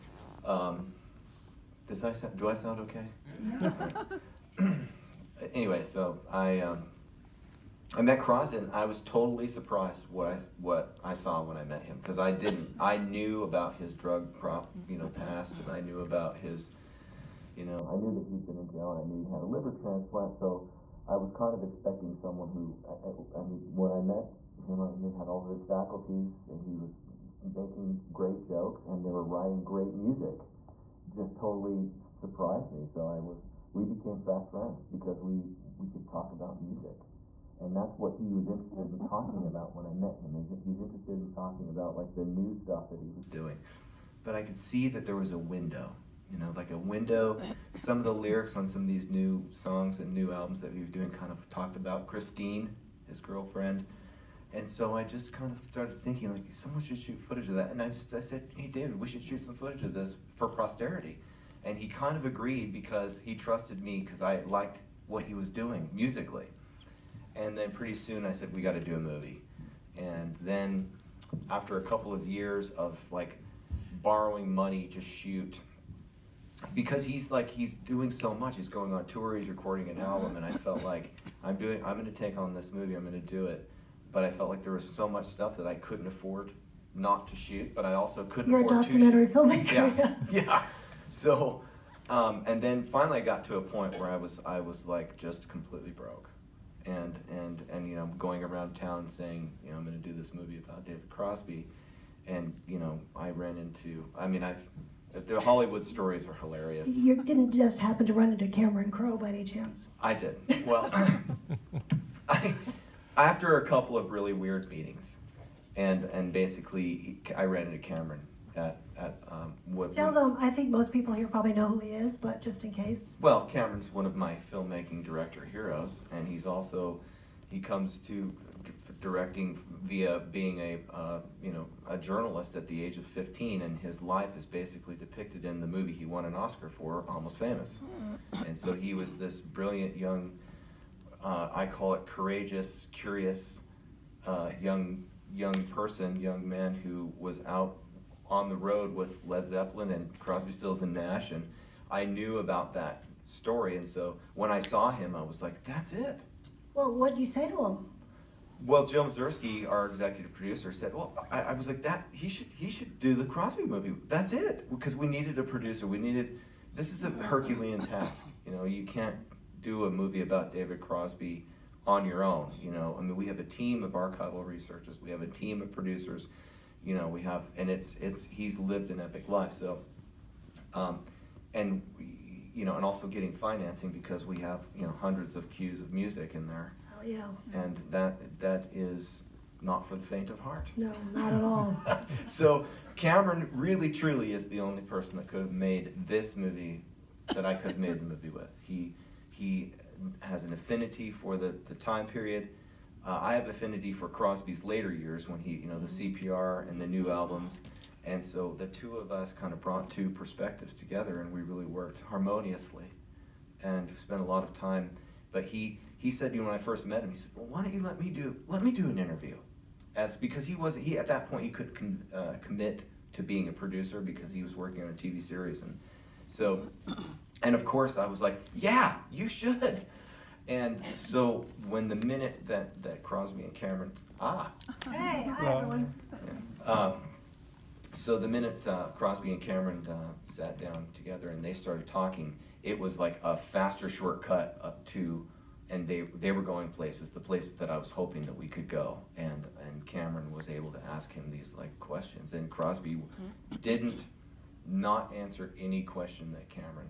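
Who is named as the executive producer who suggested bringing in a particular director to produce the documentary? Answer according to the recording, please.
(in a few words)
Jill Mazursky.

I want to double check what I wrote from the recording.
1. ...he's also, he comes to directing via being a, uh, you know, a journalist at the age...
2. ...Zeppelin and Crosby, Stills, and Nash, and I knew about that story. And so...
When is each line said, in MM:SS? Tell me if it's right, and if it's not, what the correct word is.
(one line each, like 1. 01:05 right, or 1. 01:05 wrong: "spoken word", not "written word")
1. 02:06 right
2. 02:29 right.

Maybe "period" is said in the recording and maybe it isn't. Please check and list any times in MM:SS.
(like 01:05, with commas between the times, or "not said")
03:22.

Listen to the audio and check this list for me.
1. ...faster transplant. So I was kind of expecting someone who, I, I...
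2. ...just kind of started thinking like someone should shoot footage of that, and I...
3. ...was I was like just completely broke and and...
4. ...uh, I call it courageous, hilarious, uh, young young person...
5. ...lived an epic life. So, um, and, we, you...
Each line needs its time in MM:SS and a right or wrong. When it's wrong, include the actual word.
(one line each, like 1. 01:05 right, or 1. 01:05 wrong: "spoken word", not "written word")
1. 00:19 wrong: "liver", not "faster"
2. 00:55 right
3. 01:34 right
4. 02:21 wrong: "curious", not "hilarious"
5. 02:58 right.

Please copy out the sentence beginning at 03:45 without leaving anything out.
And so, and of course I was like, yeah, you should.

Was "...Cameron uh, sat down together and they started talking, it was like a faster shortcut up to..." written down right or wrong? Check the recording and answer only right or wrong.
right.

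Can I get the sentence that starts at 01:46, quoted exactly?
You didn't just happen to run into Cameron Crowe by any chance?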